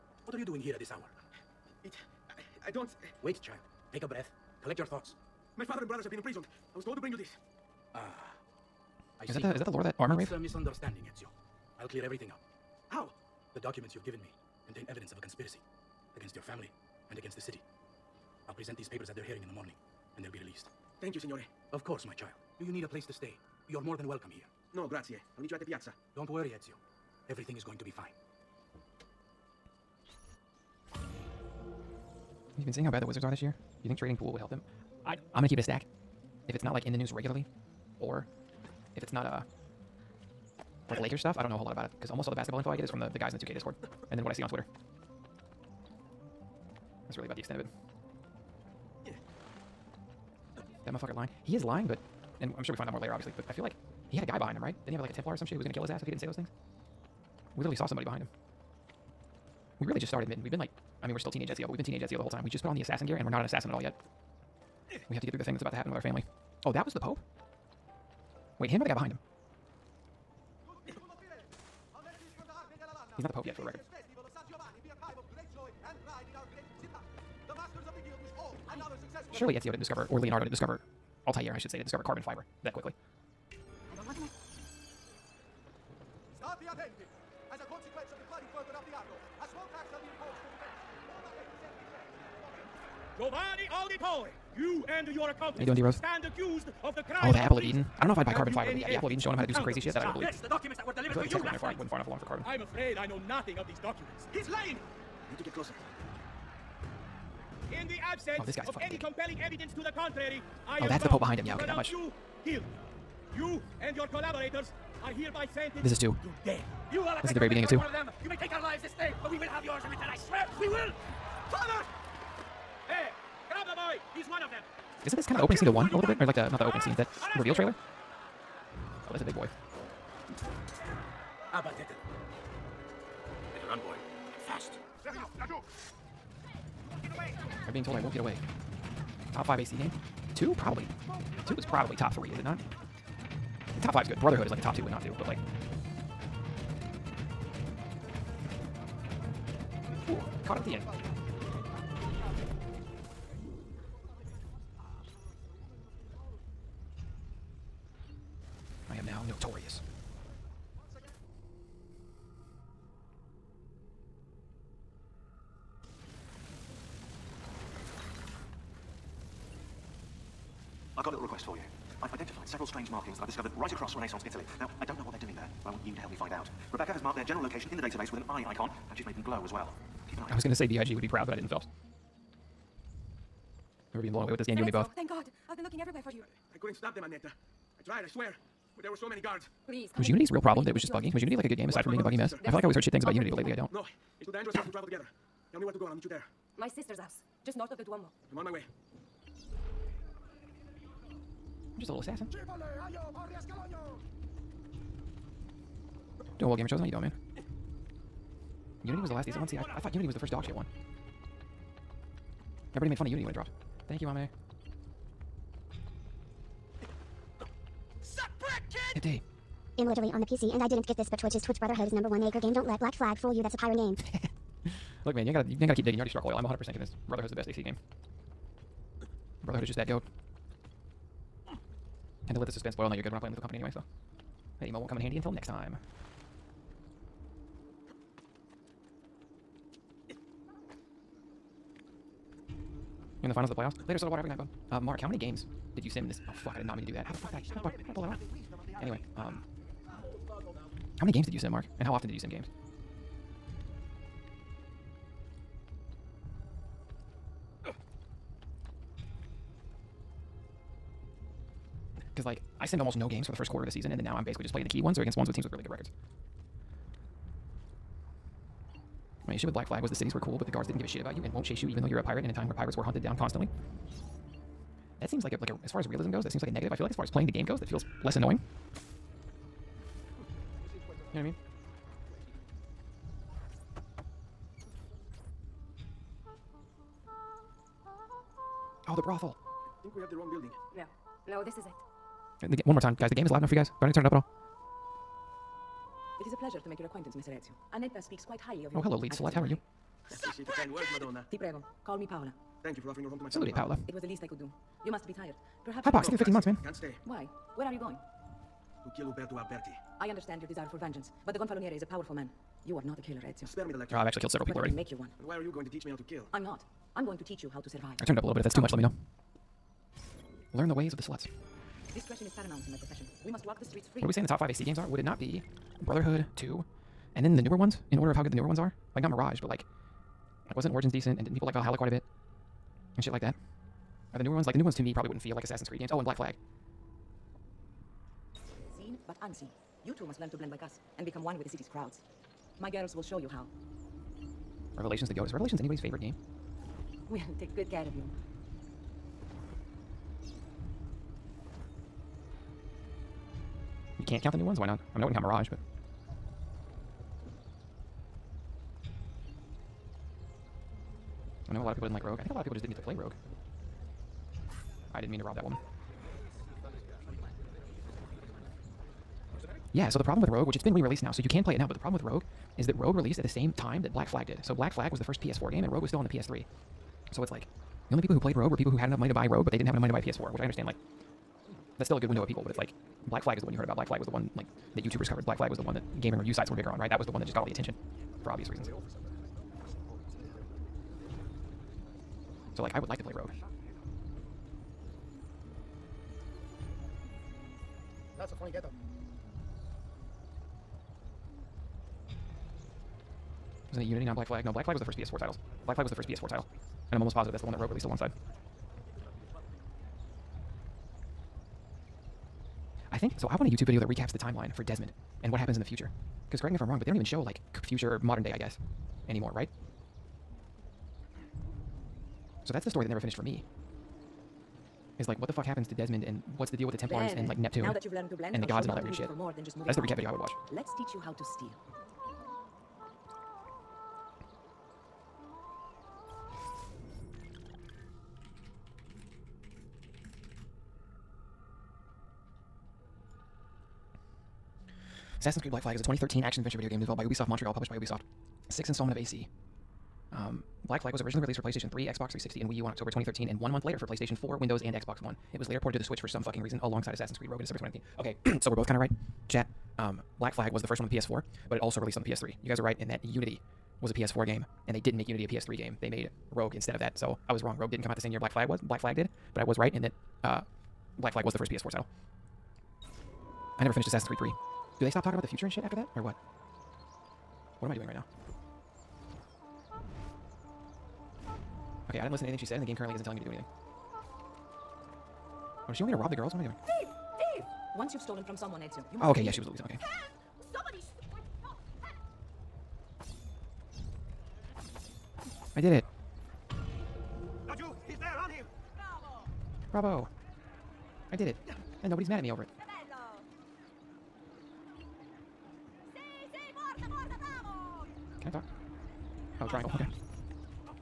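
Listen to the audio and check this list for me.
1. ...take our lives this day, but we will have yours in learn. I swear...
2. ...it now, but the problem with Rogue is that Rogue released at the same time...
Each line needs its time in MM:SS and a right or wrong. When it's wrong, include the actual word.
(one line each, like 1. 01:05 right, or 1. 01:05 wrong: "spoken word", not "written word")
1. 01:58 wrong: "return", not "learn"
2. 06:11 right.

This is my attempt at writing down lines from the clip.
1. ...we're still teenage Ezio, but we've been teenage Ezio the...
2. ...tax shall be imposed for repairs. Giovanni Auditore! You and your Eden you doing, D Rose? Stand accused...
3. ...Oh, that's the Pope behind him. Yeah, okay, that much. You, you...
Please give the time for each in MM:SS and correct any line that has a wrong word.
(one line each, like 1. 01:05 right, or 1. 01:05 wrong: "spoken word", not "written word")
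1. 01:01 right
2. 01:29 wrong: "How", not "Eden"
3. 01:50 right.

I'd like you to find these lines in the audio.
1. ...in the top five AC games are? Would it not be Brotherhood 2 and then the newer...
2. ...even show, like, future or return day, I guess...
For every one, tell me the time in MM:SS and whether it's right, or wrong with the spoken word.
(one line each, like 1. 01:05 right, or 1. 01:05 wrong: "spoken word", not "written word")
1. 05:24 right
2. 06:56 wrong: "modern", not "return".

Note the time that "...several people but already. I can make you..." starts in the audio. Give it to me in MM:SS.
05:14.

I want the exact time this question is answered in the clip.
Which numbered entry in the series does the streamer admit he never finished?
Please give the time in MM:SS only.
07:53.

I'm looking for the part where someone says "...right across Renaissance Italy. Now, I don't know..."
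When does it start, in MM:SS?
02:53.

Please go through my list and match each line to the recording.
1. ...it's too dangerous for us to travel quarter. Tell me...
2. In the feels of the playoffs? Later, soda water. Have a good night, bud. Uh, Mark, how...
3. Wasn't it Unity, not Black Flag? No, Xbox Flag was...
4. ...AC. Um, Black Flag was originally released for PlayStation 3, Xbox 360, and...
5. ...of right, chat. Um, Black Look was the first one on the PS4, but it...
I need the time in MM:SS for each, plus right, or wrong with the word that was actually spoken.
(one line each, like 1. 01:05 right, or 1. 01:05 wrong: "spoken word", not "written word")
1. 03:14 wrong: "together", not "quarter"
2. 04:03 wrong: "finals", not "feels"
3. 06:43 wrong: "Black", not "Xbox"
4. 07:28 right
5. 07:38 wrong: "Flag", not "Look".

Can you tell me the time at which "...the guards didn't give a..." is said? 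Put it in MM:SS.
04:30.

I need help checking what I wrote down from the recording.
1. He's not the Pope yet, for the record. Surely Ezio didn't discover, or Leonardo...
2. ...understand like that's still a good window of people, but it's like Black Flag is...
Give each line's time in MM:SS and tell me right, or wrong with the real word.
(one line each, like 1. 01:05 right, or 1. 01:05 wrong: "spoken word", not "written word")
1. 01:13 right
2. 06:20 right.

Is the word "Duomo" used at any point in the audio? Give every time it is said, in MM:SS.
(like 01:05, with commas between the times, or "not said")
03:17.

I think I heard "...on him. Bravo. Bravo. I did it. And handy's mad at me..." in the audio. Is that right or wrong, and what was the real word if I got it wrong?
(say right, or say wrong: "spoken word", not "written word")
wrong: "nobody", not "handy".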